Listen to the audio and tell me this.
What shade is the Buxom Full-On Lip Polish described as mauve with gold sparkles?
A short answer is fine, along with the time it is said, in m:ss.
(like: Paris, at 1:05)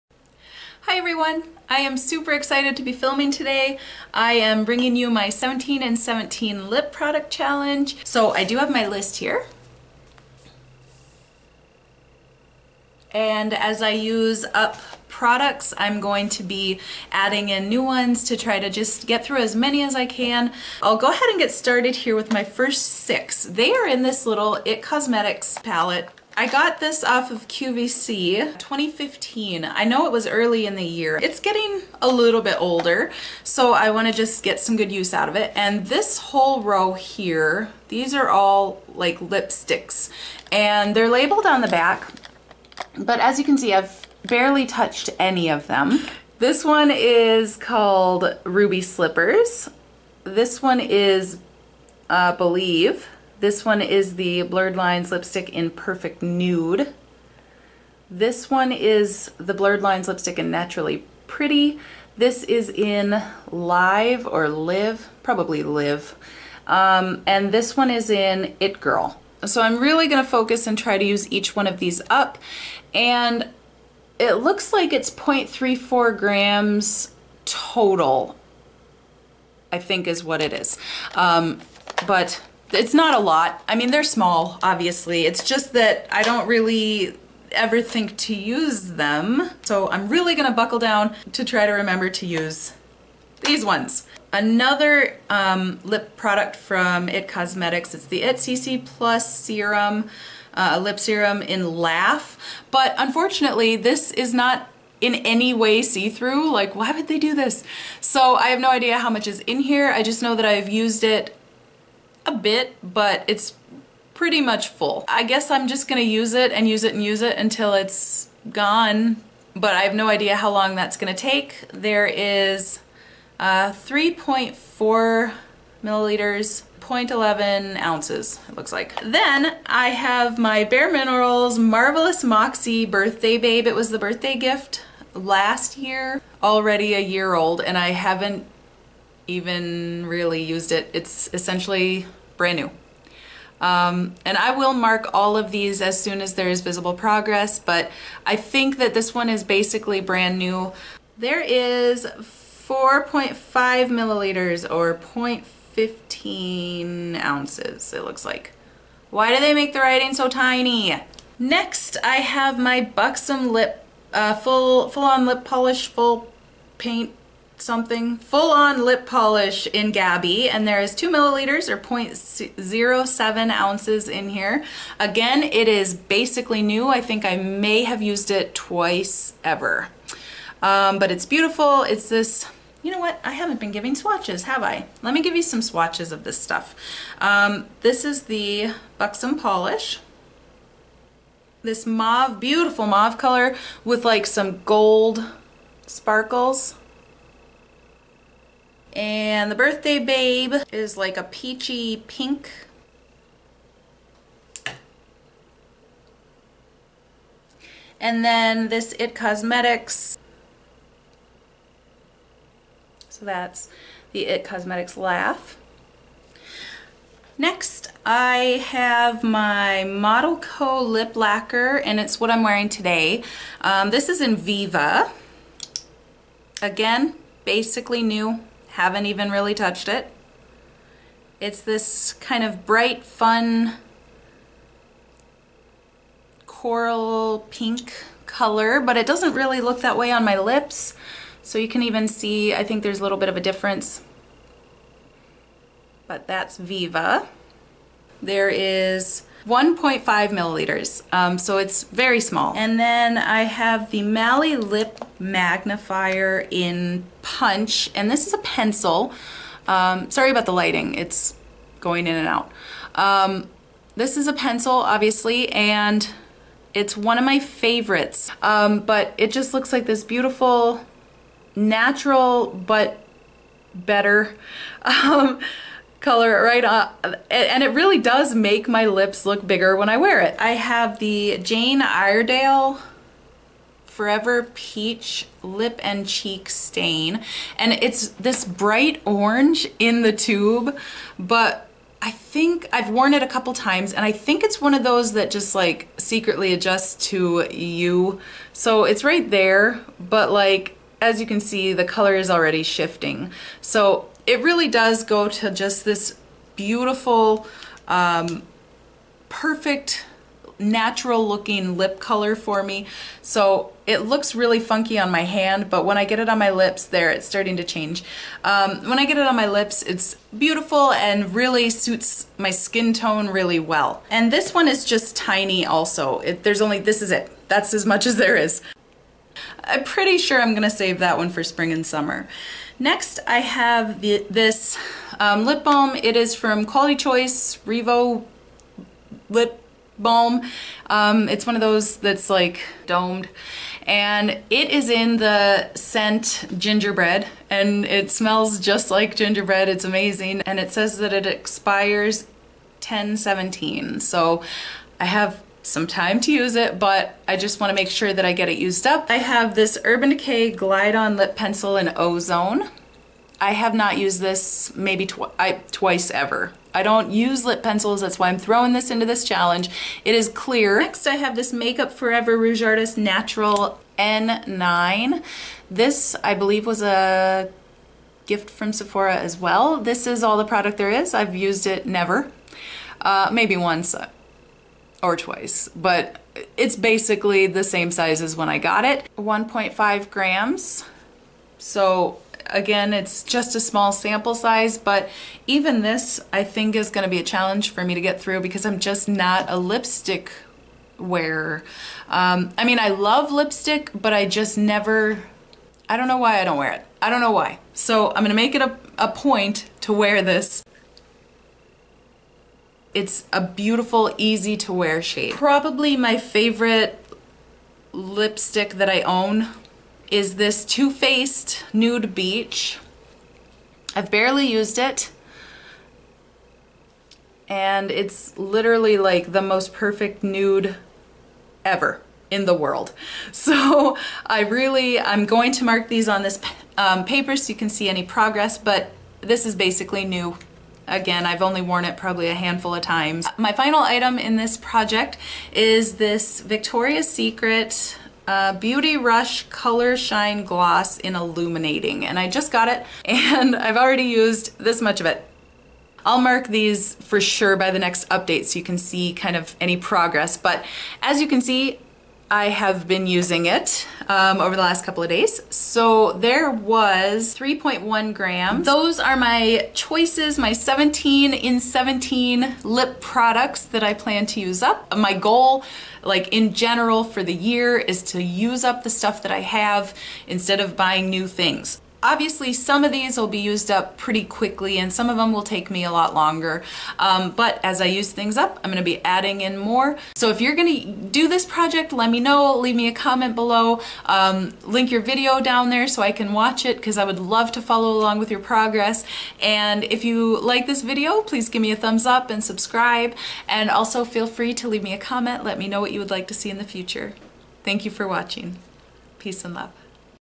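Gabby, at 2:49.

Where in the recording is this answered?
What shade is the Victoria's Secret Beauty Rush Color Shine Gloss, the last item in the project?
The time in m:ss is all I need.
7:31.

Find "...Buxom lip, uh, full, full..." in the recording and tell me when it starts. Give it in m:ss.
2:42.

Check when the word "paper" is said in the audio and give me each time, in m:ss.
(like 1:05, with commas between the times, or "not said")
7:17.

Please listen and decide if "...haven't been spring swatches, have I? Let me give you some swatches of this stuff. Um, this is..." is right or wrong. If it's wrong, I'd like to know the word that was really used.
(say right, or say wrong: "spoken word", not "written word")
wrong: "giving", not "spring".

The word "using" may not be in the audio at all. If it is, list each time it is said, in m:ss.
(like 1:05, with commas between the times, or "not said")
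7:43.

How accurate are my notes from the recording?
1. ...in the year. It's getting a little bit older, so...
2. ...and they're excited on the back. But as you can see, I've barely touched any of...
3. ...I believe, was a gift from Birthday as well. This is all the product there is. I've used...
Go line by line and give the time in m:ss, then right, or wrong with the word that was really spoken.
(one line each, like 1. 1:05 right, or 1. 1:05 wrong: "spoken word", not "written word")
1. 0:30 right
2. 0:40 wrong: "labeled", not "excited"
3. 6:16 wrong: "Sephora", not "Birthday".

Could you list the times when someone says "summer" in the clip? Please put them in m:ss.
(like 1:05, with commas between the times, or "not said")
5:31.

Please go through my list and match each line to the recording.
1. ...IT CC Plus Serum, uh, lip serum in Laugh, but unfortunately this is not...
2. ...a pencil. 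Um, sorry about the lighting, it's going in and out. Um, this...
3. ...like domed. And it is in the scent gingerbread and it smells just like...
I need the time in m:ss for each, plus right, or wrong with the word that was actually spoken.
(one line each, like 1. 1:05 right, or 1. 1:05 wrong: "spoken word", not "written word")
1. 1:38 right
2. 4:18 right
3. 5:42 right.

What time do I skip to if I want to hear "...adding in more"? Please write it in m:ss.
8:09.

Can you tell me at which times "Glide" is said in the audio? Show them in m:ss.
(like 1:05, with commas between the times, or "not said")
6:00.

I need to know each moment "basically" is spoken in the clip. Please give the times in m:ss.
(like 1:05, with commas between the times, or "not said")
2:29, 2:55, 3:47, 6:26, 7:19.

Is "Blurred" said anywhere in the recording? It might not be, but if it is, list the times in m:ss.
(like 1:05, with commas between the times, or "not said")
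0:54, 0:59.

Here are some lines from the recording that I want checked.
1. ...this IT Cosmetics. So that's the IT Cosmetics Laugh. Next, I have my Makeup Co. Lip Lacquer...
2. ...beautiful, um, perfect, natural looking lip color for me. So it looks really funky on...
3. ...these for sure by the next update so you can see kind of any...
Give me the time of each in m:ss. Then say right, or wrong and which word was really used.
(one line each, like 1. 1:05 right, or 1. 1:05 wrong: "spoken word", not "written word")
1. 3:28 wrong: "Model", not "Makeup"
2. 5:06 right
3. 7:36 right.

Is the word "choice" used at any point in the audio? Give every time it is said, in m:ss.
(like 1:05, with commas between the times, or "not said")
5:36, 7:49.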